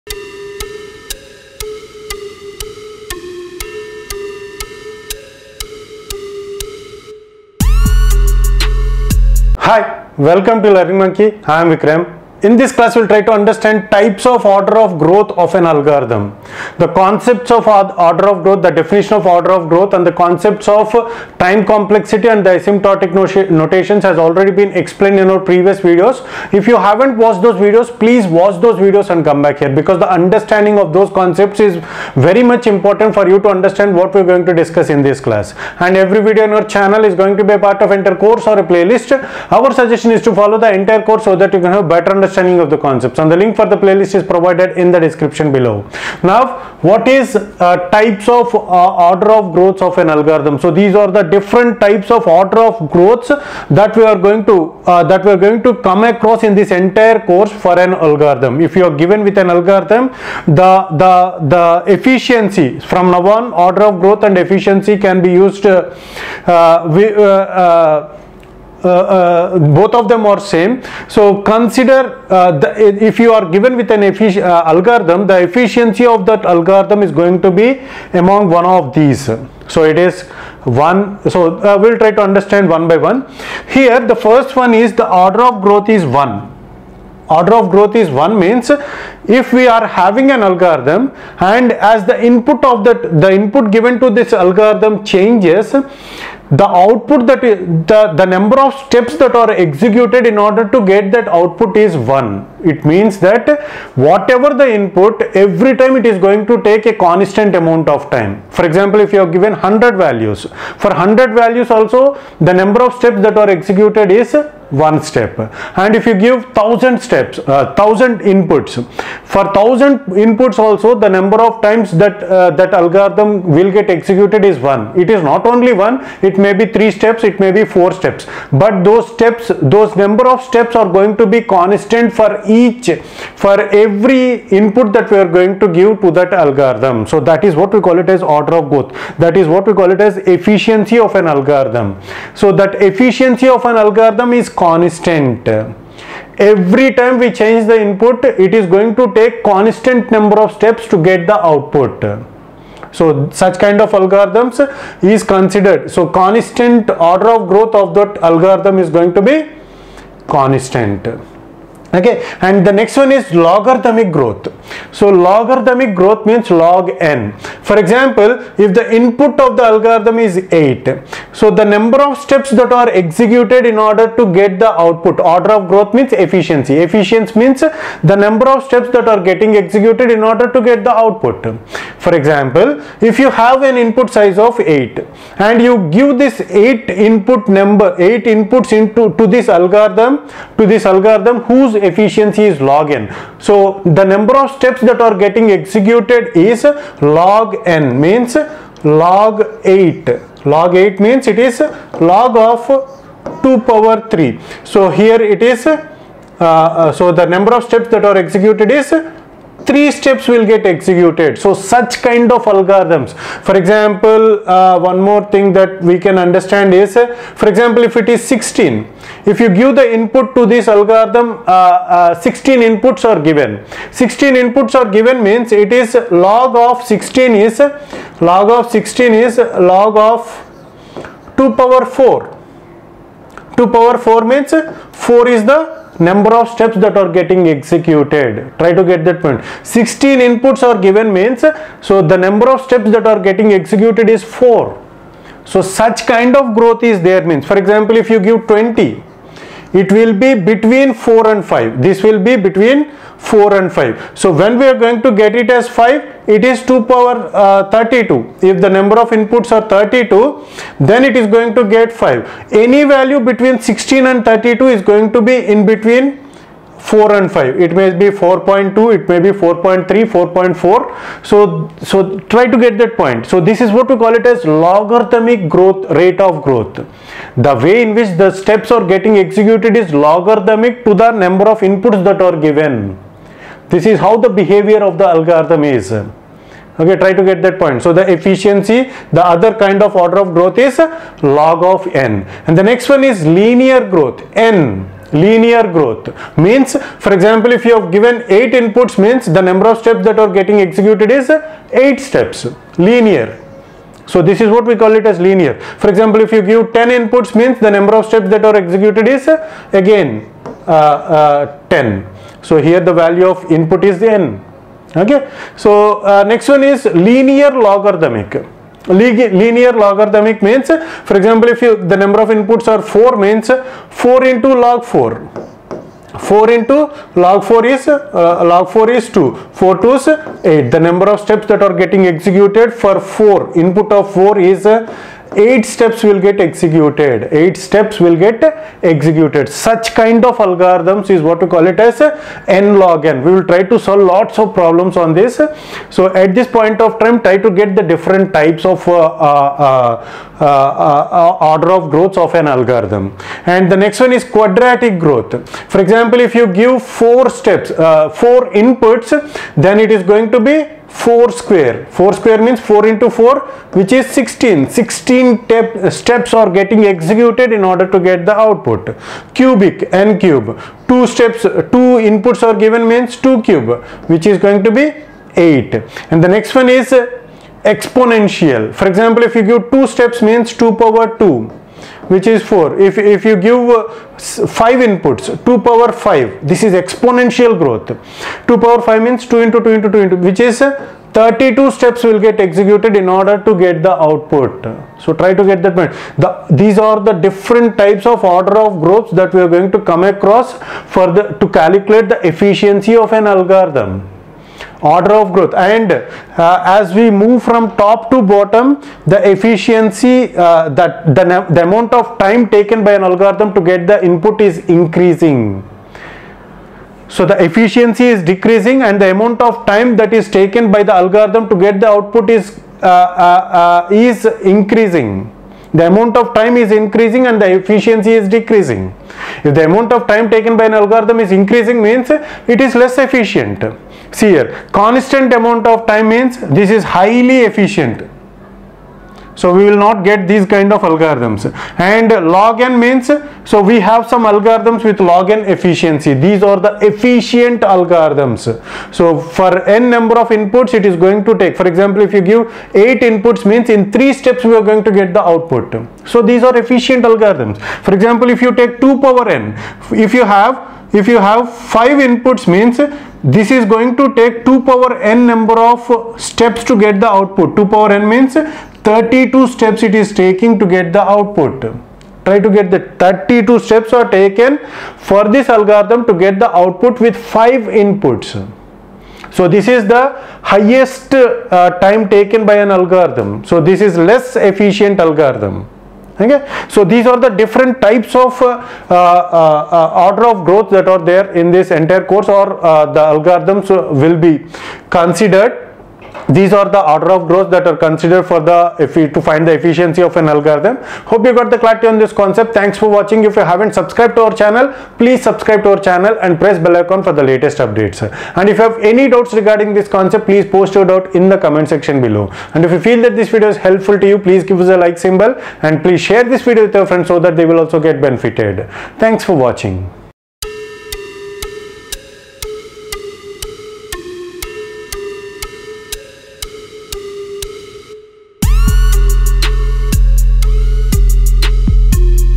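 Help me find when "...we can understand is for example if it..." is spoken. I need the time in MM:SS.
03:35.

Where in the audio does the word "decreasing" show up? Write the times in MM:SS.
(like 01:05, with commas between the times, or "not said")
06:58, 07:08.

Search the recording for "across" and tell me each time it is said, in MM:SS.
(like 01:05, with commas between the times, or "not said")
00:56, 06:40.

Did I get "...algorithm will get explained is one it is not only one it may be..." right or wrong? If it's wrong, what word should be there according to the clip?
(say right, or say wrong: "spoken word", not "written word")
wrong: "executed", not "explained".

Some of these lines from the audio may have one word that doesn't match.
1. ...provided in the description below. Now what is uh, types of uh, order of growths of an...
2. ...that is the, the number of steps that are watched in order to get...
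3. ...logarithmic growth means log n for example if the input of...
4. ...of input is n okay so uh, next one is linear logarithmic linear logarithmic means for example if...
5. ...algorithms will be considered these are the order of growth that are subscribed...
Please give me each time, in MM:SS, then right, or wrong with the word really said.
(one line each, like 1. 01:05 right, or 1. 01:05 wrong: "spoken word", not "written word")
1. 00:44 right
2. 01:37 wrong: "executed", not "watched"
3. 02:45 right
4. 05:13 right
5. 08:13 wrong: "considered", not "subscribed".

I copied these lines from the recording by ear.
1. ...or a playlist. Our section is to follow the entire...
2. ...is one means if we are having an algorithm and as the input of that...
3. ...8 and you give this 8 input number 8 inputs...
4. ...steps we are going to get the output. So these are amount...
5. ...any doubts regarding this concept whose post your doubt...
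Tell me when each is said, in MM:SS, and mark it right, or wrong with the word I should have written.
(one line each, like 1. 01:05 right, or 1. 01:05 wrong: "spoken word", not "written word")
1. 00:38 wrong: "suggestion", not "section"
2. 01:27 right
3. 03:04 right
4. 07:34 wrong: "efficient", not "amount"
5. 08:28 wrong: "please", not "whose".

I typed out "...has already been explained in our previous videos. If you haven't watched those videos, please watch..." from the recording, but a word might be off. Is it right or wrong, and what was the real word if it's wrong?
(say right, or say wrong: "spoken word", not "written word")
right.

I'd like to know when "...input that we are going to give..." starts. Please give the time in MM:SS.
02:14.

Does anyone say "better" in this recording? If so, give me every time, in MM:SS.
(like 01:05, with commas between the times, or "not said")
00:41.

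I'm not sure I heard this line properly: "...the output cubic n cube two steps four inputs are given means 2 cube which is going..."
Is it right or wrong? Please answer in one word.
wrong.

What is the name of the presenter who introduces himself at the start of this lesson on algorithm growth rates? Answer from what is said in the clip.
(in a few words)
Vikram.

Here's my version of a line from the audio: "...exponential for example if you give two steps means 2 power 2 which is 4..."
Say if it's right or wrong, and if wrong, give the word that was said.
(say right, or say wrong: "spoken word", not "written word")
right.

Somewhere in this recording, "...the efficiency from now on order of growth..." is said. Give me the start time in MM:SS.
01:01.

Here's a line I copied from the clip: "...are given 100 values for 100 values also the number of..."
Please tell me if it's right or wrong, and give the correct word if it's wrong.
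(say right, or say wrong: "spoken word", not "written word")
right.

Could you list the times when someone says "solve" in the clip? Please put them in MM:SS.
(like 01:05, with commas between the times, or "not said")
05:43.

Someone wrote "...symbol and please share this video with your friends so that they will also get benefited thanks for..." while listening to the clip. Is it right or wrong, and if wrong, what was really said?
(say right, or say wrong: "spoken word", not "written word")
right.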